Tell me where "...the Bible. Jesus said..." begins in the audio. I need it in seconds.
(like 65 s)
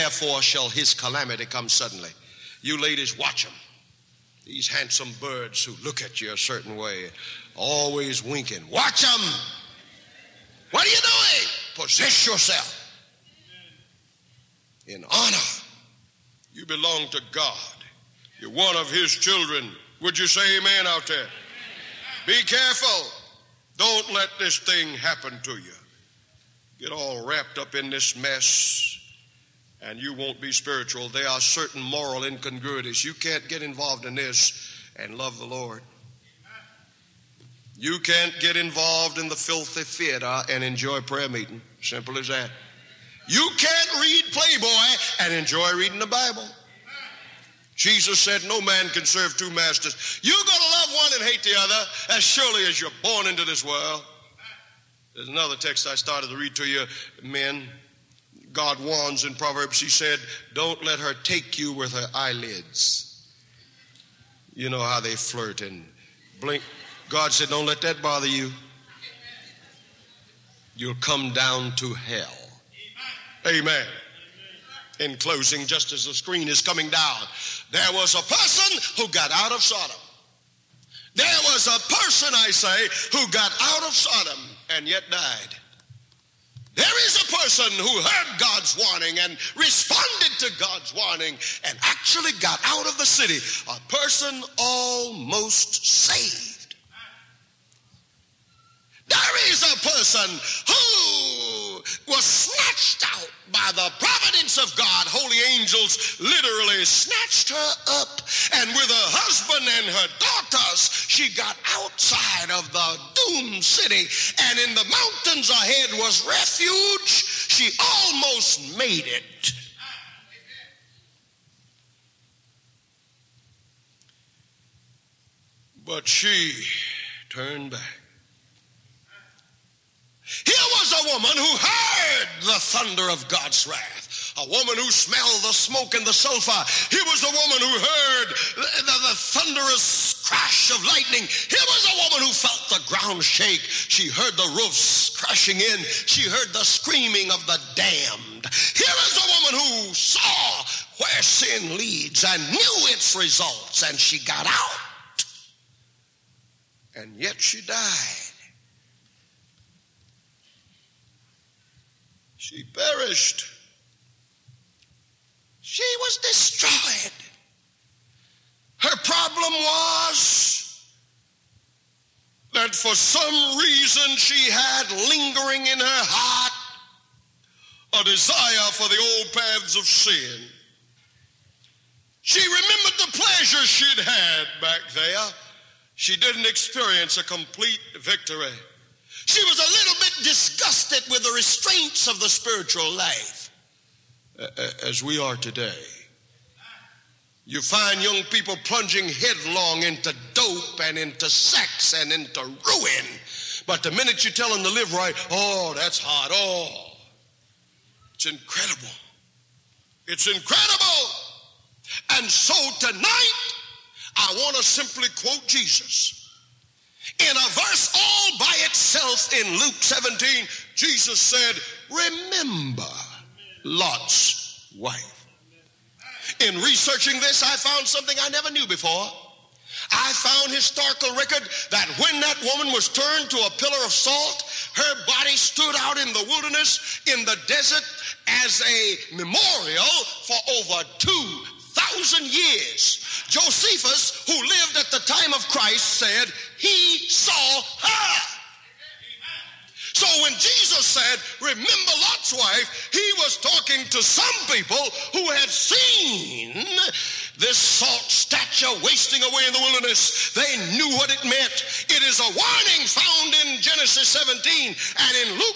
45 s.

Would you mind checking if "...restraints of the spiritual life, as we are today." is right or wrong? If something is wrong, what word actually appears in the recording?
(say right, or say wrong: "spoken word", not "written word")
right.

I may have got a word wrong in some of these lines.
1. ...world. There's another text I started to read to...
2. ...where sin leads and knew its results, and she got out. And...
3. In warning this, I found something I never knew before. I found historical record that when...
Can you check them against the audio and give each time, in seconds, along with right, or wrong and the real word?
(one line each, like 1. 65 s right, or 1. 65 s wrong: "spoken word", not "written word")
1. 53 s right
2. 150 s right
3. 226 s wrong: "researching", not "warning".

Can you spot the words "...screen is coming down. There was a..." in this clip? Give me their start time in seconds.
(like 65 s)
76 s.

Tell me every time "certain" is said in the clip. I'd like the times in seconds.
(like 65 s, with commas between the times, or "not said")
6 s, 31 s.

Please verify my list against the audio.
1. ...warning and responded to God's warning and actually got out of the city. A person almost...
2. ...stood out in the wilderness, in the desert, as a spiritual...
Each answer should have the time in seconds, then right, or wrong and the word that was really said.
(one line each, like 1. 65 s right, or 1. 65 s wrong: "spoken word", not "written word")
1. 88 s right
2. 235 s wrong: "memorial", not "spiritual".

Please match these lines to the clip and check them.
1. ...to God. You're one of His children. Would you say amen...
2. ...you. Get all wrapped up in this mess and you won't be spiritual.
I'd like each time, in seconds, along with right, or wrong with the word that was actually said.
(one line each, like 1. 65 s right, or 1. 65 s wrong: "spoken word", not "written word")
1. 17 s right
2. 25 s right.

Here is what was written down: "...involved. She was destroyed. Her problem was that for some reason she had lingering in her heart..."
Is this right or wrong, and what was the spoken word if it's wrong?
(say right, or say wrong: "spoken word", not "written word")
wrong: "perished", not "involved".